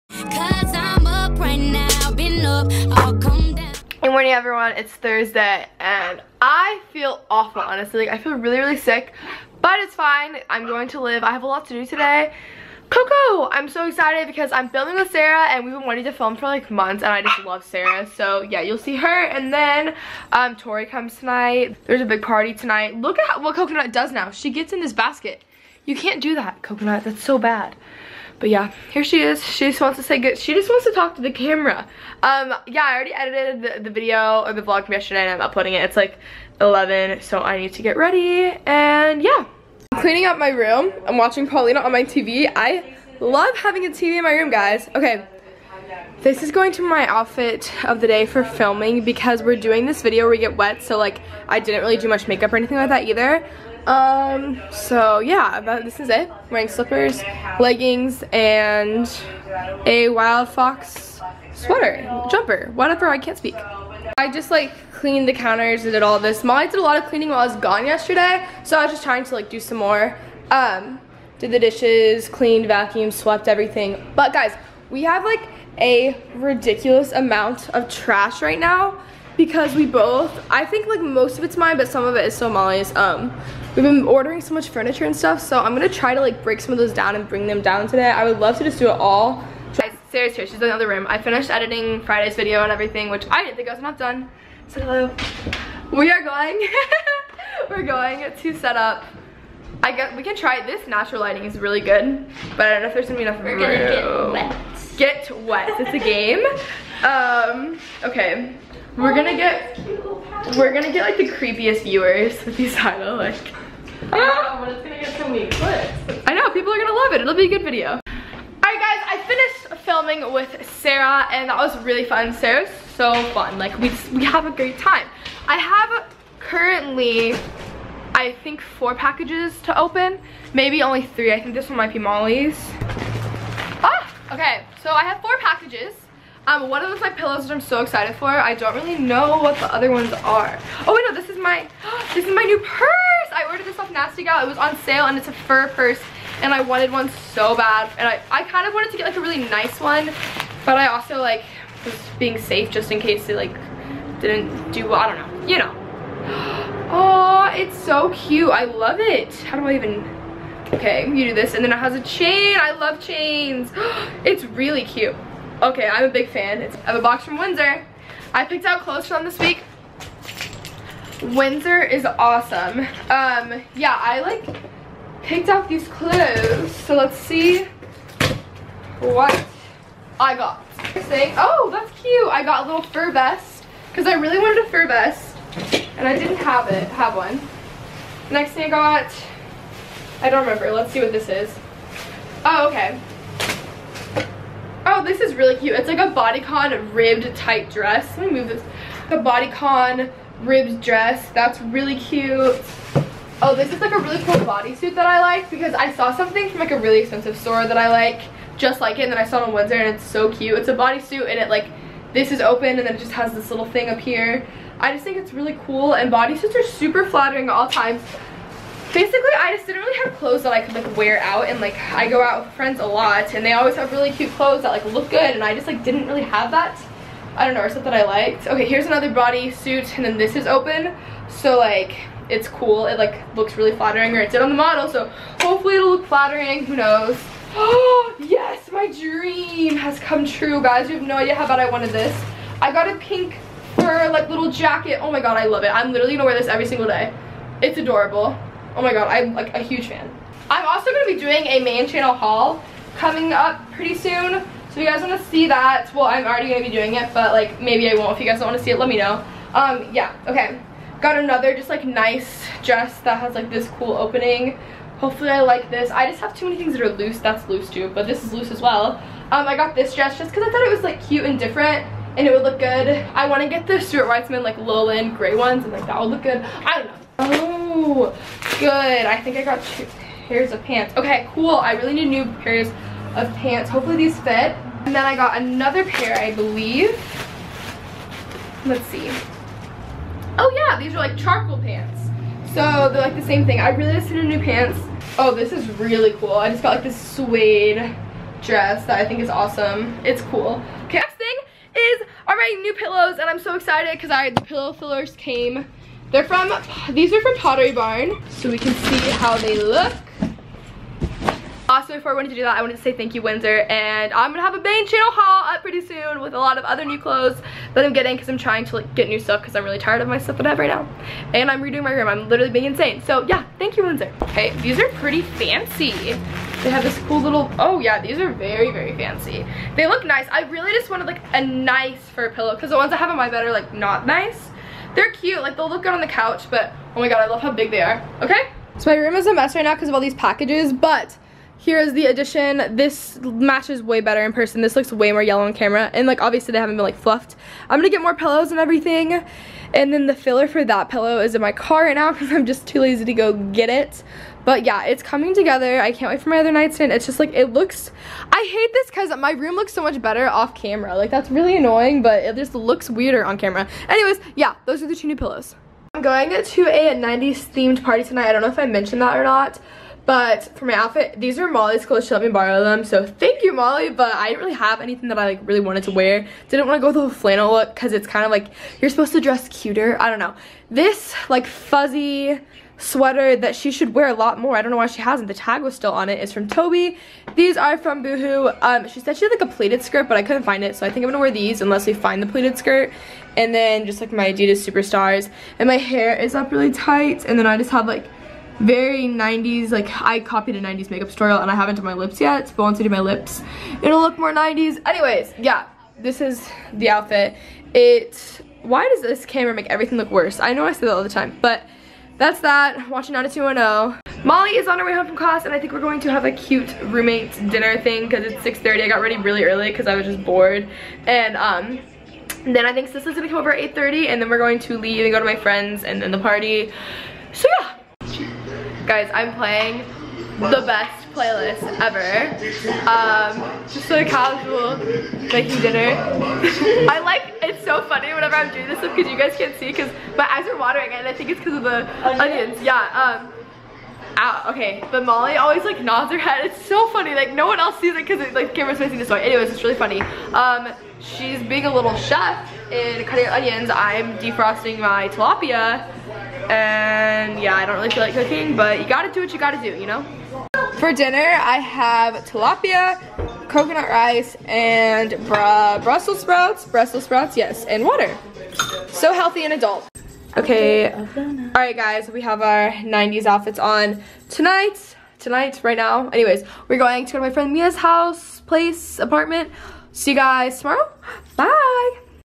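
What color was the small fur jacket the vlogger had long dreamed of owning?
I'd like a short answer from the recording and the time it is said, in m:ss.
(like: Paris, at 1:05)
Pink, at 4:02.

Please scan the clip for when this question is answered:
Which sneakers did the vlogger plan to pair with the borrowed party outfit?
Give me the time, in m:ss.
6:34.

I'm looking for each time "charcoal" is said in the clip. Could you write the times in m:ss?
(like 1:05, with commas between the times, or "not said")
4:51.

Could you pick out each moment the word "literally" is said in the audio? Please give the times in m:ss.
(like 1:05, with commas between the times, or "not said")
4:05, 5:22.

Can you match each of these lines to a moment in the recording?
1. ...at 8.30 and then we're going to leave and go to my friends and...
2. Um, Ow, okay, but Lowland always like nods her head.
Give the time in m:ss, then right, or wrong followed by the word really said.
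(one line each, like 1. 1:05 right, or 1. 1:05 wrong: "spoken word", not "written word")
1. 7:03 right
2. 7:23 wrong: "Molly", not "Lowland".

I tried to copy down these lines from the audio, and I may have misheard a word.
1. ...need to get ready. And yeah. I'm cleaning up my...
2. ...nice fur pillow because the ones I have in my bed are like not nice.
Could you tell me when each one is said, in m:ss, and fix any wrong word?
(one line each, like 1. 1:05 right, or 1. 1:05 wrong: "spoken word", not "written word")
1. 0:37 right
2. 5:31 right.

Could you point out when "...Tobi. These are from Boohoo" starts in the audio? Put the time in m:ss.
6:26.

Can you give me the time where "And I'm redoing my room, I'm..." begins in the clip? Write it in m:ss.
5:21.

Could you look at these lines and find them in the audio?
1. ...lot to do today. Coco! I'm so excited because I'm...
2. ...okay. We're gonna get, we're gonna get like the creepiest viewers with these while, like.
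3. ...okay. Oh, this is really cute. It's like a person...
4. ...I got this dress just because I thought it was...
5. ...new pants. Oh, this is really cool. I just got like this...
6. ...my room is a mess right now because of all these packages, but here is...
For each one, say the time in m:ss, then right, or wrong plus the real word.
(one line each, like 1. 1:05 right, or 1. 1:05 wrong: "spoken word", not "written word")
1. 0:11 right
2. 1:48 wrong: "title", not "while"
3. 3:12 wrong: "bodycon", not "person"
4. 4:29 right
5. 4:54 right
6. 5:38 right.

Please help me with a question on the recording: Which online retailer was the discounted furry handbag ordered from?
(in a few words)
Nasty Gal.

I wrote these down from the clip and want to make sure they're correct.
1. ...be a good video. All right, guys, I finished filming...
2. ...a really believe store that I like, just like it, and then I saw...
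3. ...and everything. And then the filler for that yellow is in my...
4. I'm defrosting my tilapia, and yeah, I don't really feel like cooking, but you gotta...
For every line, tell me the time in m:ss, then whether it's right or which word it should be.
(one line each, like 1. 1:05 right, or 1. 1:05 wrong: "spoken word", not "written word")
1. 1:57 right
2. 3:26 wrong: "expensive", not "believe"
3. 5:48 wrong: "pillow", not "yellow"
4. 7:33 right.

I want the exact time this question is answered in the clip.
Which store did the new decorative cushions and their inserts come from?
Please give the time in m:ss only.
5:07.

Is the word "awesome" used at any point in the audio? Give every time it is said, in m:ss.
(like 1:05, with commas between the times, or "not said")
2:52, 4:59.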